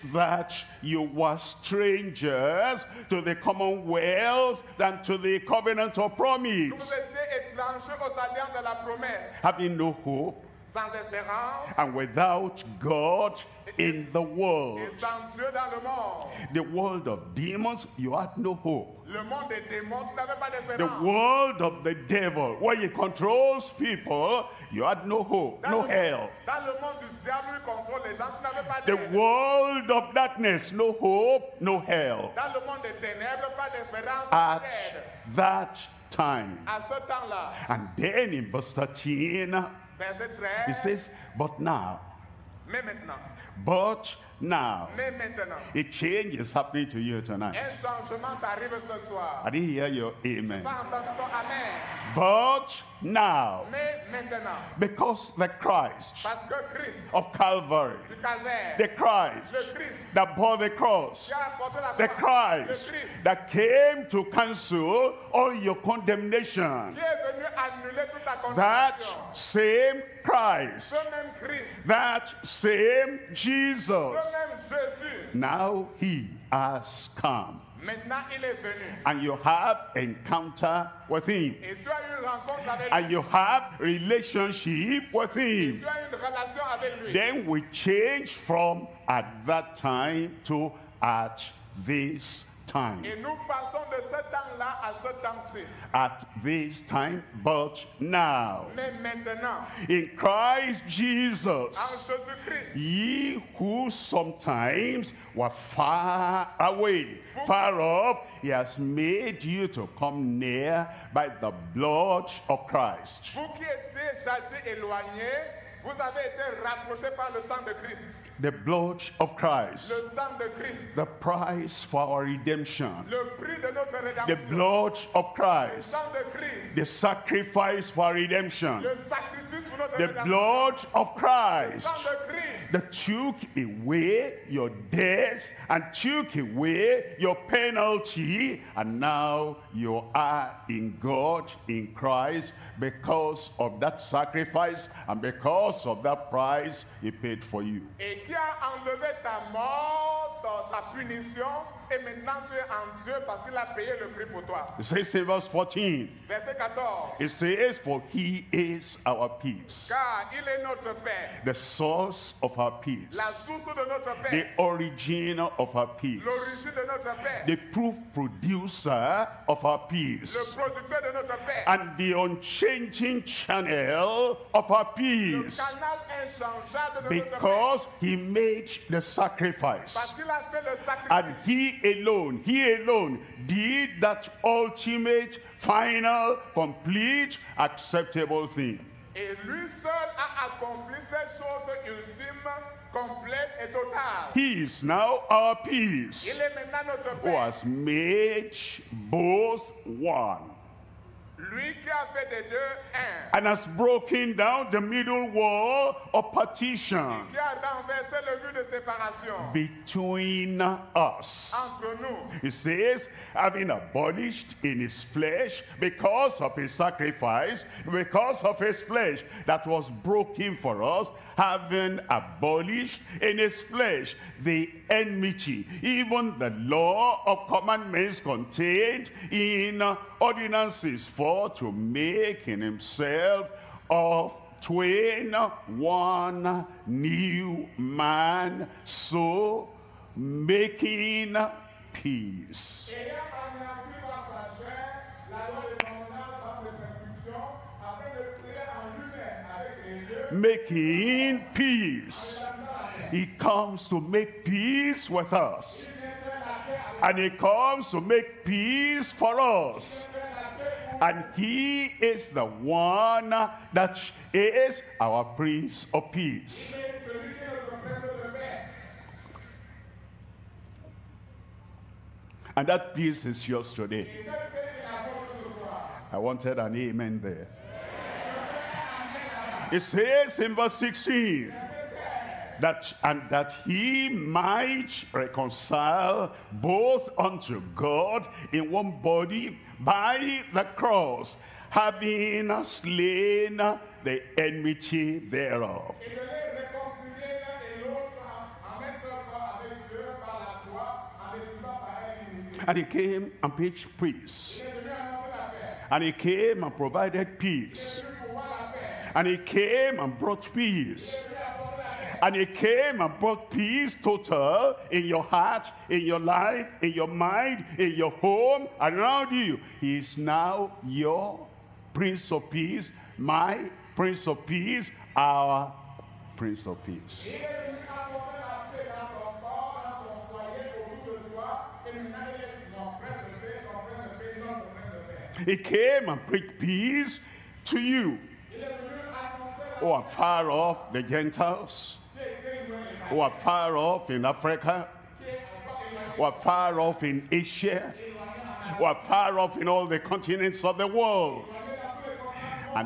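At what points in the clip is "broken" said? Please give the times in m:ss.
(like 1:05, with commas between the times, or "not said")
3:23, 3:40.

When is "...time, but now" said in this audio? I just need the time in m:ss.
1:36.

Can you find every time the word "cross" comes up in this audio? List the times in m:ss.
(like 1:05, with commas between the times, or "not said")
1:00, 4:50.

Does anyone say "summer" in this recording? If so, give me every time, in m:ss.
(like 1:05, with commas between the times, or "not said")
not said.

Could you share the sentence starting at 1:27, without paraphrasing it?
Then we change from at that time to at this time.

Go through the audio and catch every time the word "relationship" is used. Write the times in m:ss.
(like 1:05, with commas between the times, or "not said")
1:23.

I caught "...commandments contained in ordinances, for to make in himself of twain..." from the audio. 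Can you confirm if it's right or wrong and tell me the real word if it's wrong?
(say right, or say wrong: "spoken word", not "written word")
right.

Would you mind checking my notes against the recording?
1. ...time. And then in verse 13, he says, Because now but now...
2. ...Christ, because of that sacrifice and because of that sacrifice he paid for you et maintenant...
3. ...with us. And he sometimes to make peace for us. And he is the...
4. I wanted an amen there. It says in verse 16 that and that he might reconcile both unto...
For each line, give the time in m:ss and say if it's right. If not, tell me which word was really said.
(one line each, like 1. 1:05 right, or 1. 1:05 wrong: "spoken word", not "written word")
1. 0:36 wrong: "But", not "Because"
2. 2:21 wrong: "price", not "sacrifice"
3. 4:15 wrong: "comes", not "sometimes"
4. 4:36 right.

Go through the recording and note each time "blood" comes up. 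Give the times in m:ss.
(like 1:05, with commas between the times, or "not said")
1:51, 1:58, 2:04, 2:10.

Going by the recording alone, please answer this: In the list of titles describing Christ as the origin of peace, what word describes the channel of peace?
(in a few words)
unchanging.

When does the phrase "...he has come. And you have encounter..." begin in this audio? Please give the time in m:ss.
1:15.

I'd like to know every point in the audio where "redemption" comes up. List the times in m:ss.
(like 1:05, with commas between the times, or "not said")
2:02, 2:08.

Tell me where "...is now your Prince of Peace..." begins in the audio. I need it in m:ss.
5:19.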